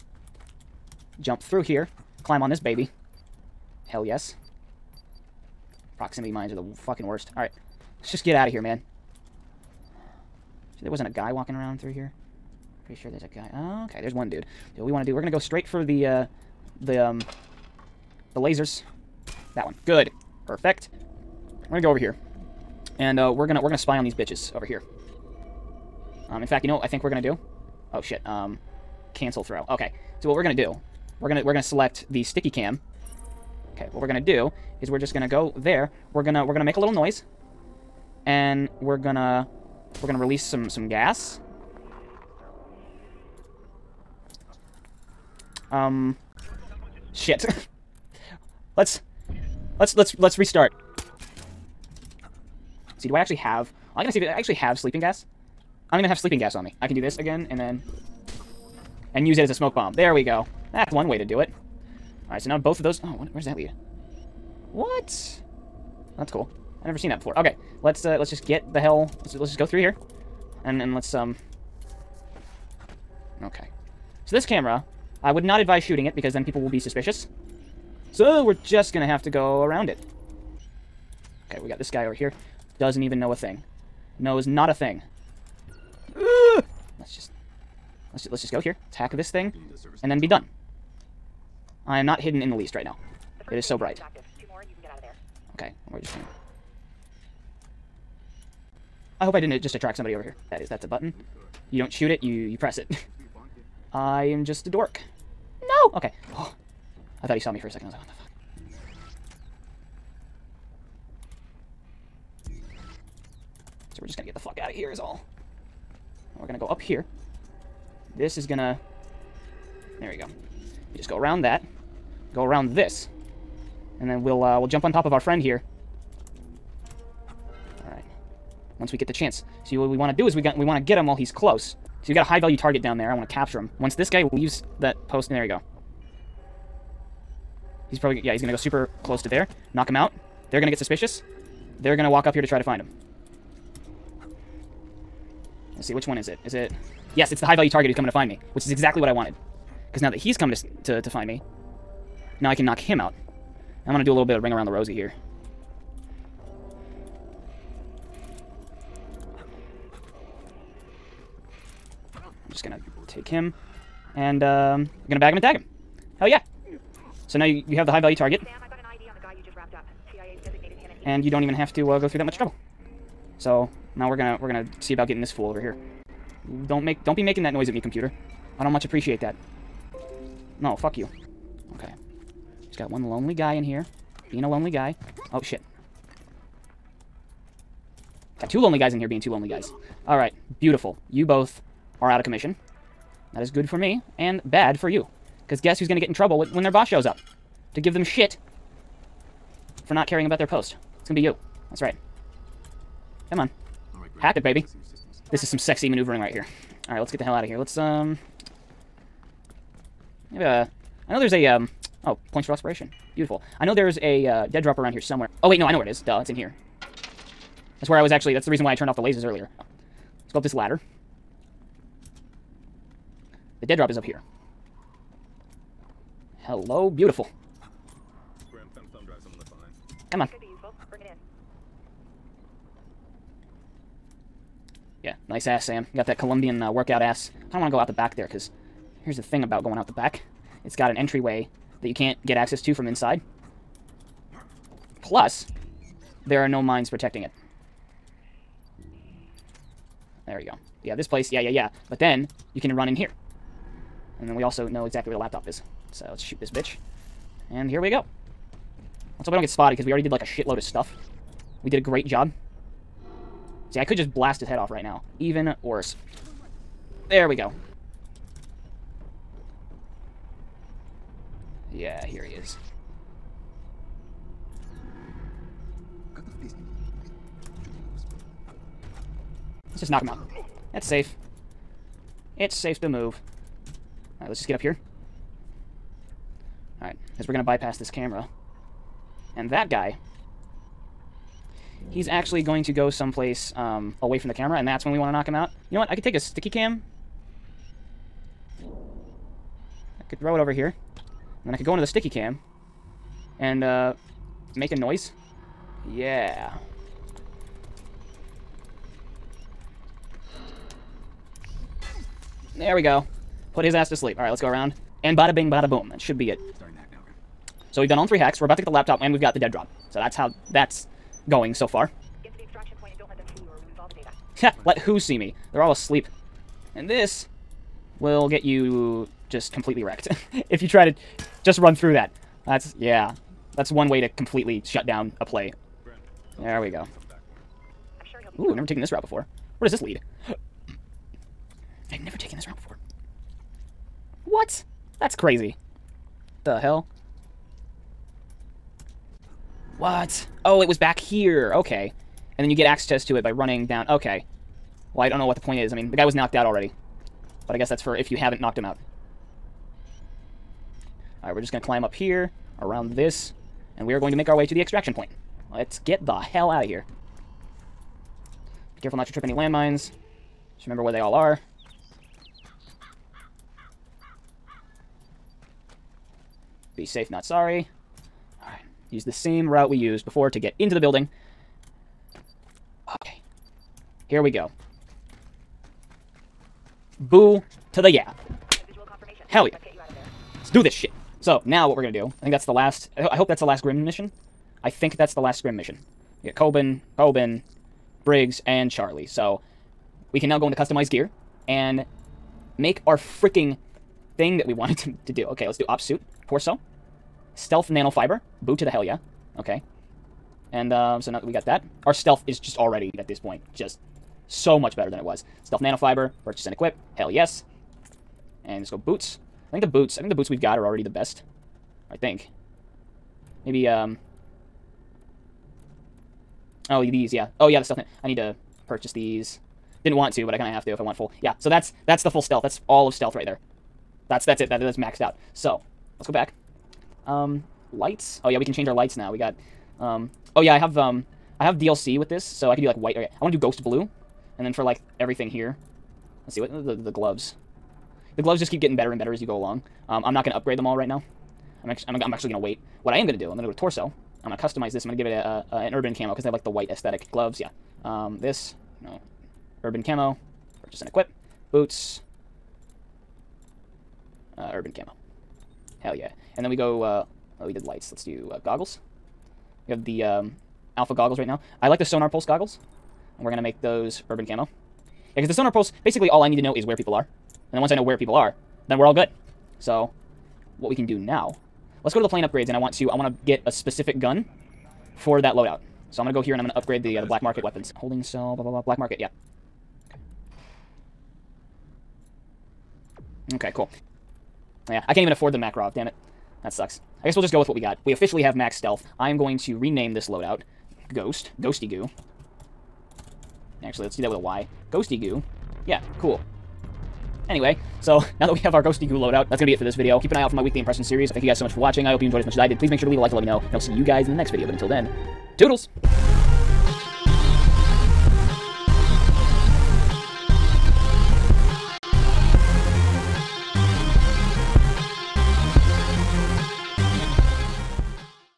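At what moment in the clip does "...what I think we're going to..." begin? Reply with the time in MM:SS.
00:26.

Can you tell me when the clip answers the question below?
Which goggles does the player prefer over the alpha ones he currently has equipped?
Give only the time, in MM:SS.
07:51.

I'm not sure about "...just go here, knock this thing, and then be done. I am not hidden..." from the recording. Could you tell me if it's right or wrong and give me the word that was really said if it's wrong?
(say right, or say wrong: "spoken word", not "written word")
wrong: "attack", not "knock".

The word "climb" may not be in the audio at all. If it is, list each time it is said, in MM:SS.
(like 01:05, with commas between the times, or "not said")
00:02, 06:01.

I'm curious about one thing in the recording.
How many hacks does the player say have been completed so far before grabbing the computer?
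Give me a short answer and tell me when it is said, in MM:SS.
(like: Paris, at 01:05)
3, at 05:18.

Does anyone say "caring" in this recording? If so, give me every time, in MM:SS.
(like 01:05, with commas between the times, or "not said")
03:20.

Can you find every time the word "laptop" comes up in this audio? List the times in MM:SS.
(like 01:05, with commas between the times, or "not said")
04:15, 05:18.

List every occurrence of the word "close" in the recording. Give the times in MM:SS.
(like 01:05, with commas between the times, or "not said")
02:11, 02:19.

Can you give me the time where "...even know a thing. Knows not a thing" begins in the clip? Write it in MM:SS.
01:23.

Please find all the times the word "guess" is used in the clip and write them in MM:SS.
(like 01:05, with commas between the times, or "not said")
03:15, 05:57, 08:17.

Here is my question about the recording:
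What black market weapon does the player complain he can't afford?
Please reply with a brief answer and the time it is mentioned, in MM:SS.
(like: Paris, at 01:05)
Makarov, at 08:15.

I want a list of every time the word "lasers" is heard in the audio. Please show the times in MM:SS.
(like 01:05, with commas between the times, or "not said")
00:18, 03:39.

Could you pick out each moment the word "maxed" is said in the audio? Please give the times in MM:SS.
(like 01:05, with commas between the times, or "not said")
07:14.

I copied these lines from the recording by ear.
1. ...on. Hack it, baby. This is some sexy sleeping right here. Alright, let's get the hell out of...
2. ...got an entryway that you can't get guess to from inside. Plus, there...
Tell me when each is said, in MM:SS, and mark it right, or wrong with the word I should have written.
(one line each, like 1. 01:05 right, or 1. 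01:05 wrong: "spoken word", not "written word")
1. 03:23 wrong: "maneuvering", not "sleeping"
2. 04:00 wrong: "access", not "guess".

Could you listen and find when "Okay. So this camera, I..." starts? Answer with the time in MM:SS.
01:13.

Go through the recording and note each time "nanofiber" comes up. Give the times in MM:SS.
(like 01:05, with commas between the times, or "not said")
06:47, 06:55.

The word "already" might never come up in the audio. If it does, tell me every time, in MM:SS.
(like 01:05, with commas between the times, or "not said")
04:19, 05:56, 06:52, 07:00.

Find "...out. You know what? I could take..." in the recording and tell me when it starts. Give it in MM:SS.
04:55.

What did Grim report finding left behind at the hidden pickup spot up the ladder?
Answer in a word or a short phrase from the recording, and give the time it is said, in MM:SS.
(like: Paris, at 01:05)
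A thumb drive, at 03:48.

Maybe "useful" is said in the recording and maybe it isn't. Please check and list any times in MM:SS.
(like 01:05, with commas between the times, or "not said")
03:50.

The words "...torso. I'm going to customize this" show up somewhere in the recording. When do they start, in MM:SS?
07:33.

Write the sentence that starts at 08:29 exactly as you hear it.
Keep an eye out for my weekly impression series.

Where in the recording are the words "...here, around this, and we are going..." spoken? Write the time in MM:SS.
06:01.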